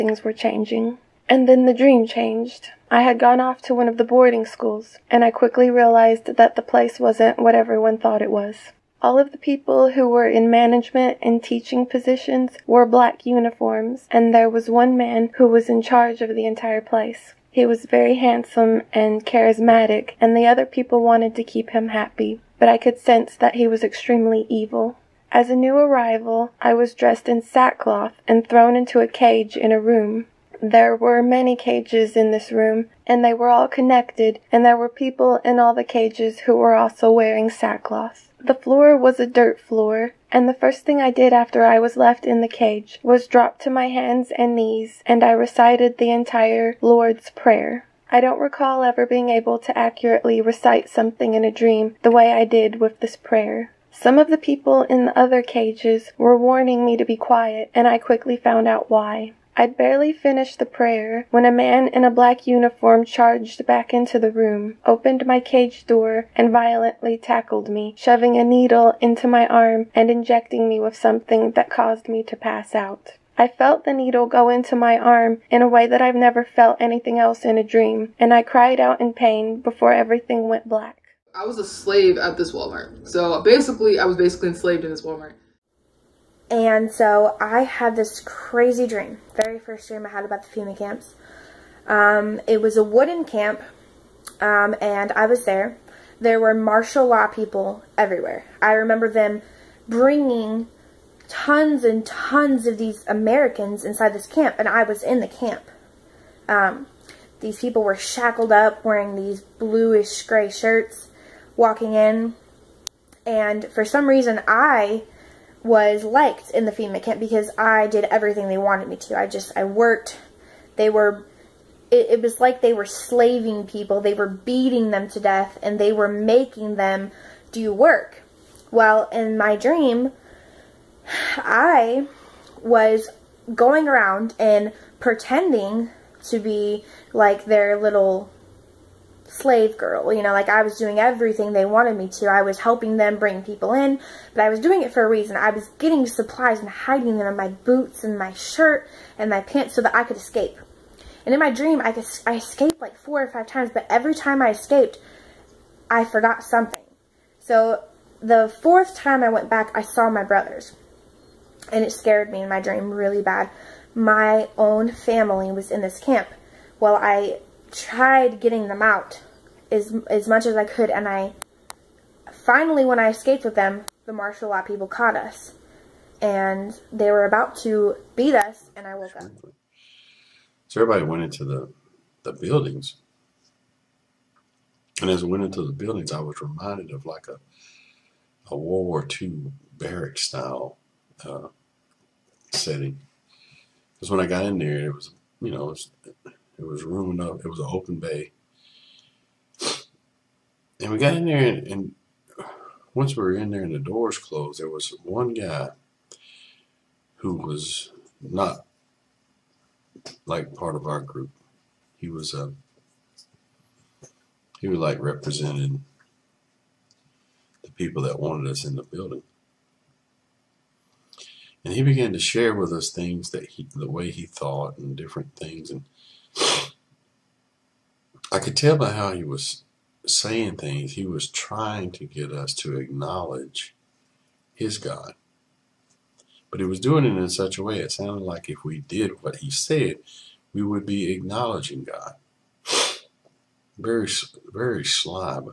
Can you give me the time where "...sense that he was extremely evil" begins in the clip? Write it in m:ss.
0:22.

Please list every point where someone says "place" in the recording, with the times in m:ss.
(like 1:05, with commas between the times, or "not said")
0:06, 0:16.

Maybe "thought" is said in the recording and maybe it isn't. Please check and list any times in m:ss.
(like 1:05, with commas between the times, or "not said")
0:07, 3:44.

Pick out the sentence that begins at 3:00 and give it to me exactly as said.
So everybody went into the, the buildings.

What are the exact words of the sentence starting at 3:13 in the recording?
Because when I got in there, it was, you know, it was it was room enough.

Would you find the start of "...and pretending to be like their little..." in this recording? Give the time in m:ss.
2:14.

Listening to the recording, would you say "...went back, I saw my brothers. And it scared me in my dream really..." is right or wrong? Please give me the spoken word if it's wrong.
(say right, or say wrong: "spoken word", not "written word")
right.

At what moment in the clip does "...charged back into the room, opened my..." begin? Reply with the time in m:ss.
1:03.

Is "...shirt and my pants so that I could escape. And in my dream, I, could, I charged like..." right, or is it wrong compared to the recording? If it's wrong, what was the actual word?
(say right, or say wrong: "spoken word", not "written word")
wrong: "escaped", not "charged".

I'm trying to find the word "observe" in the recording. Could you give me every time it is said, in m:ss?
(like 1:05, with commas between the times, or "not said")
not said.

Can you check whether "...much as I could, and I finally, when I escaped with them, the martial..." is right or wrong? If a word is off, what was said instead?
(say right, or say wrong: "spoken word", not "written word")
right.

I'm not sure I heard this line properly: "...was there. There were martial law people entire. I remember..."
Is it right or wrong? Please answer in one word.
wrong.